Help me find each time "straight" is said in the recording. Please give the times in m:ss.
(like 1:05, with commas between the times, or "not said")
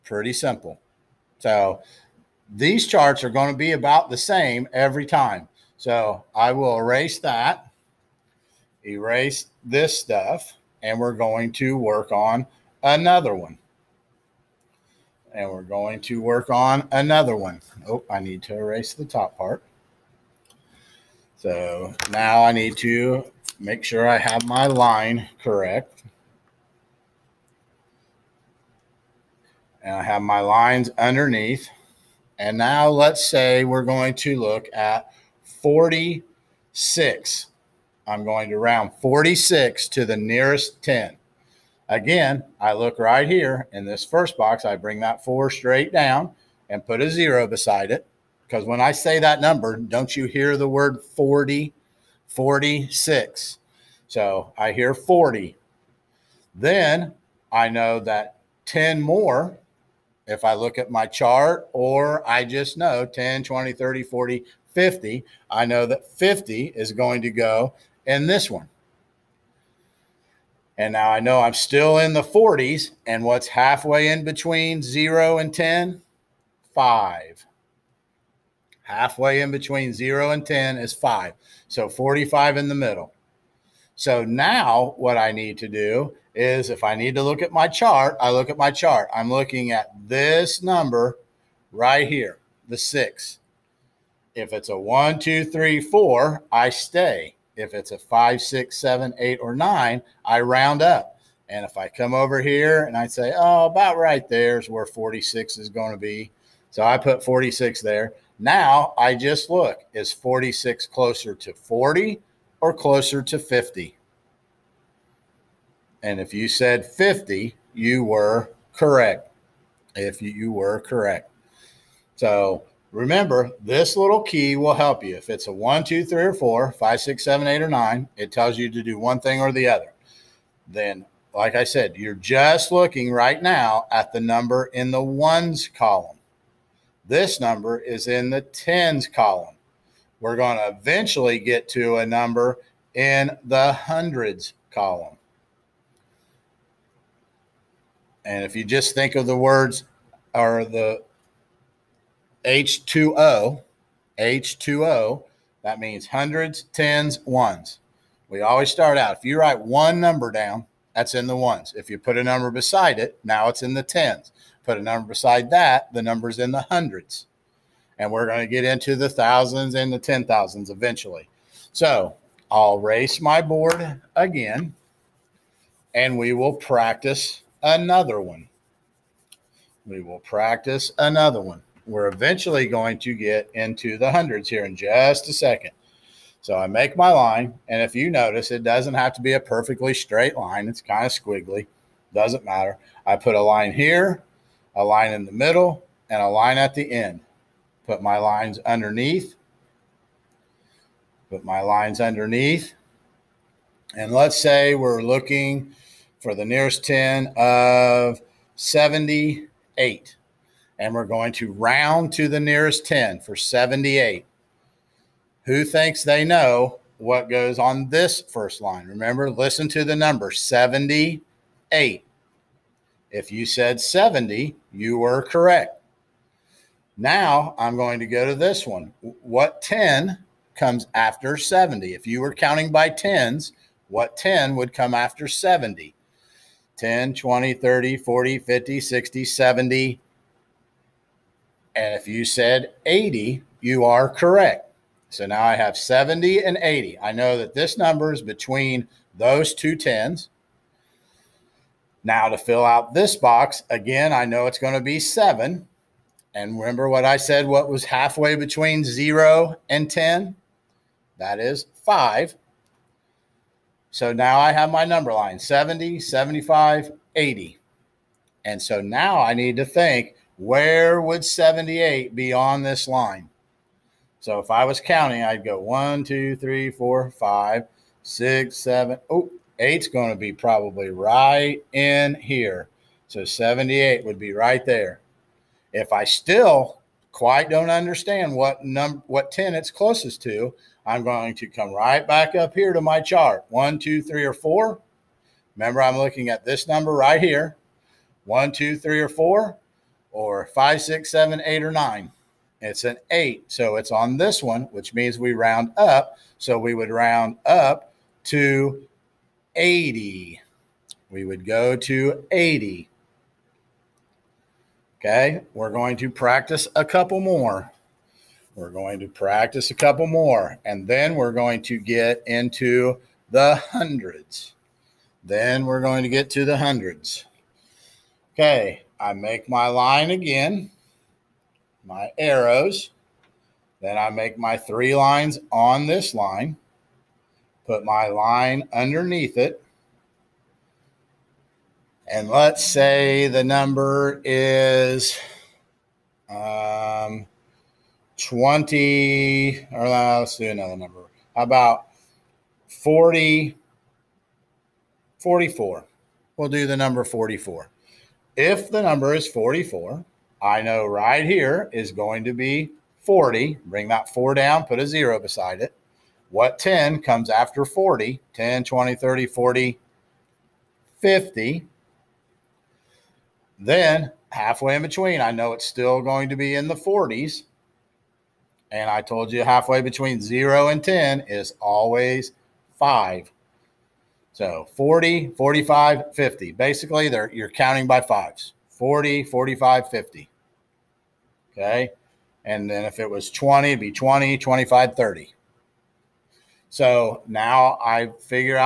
0:45, 3:09.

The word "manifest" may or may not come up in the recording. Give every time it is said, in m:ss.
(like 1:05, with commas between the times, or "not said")
not said.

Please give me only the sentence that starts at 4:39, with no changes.
Oh, eight's going to be probably right in here.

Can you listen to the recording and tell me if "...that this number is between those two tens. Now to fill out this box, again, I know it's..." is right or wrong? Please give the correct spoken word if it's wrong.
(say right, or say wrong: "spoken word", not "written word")
right.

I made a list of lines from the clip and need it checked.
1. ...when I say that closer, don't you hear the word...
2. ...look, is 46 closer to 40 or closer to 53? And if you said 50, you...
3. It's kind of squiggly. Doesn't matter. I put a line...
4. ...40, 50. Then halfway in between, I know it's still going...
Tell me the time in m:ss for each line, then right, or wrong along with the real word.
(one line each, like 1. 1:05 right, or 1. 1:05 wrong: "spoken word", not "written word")
1. 0:48 wrong: "number", not "closer"
2. 1:49 wrong: "50", not "53"
3. 3:10 right
4. 6:09 right.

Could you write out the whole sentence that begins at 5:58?
If the number is 44, I know right here is going to be 40.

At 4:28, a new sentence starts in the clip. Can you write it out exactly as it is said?
And so now I need to think where would 78 be on this line?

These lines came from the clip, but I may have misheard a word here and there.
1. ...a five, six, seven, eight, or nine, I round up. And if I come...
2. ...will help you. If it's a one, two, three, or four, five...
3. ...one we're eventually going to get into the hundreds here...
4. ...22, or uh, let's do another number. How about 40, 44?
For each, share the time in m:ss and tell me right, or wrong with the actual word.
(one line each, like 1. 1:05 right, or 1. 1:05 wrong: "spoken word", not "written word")
1. 1:37 right
2. 2:04 right
3. 3:01 right
4. 5:48 wrong: "20", not "22".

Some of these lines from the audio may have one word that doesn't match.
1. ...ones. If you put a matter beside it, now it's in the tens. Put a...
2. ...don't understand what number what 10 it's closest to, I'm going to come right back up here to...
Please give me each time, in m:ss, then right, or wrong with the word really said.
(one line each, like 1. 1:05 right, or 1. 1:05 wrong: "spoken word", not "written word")
1. 2:41 wrong: "number", not "matter"
2. 4:47 right.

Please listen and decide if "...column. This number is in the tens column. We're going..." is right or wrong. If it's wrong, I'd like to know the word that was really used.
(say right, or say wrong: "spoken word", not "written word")
right.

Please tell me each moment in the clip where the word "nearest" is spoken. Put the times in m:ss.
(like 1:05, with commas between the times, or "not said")
0:40, 3:26, 3:32.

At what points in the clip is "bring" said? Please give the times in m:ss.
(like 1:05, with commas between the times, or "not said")
0:44, 6:03.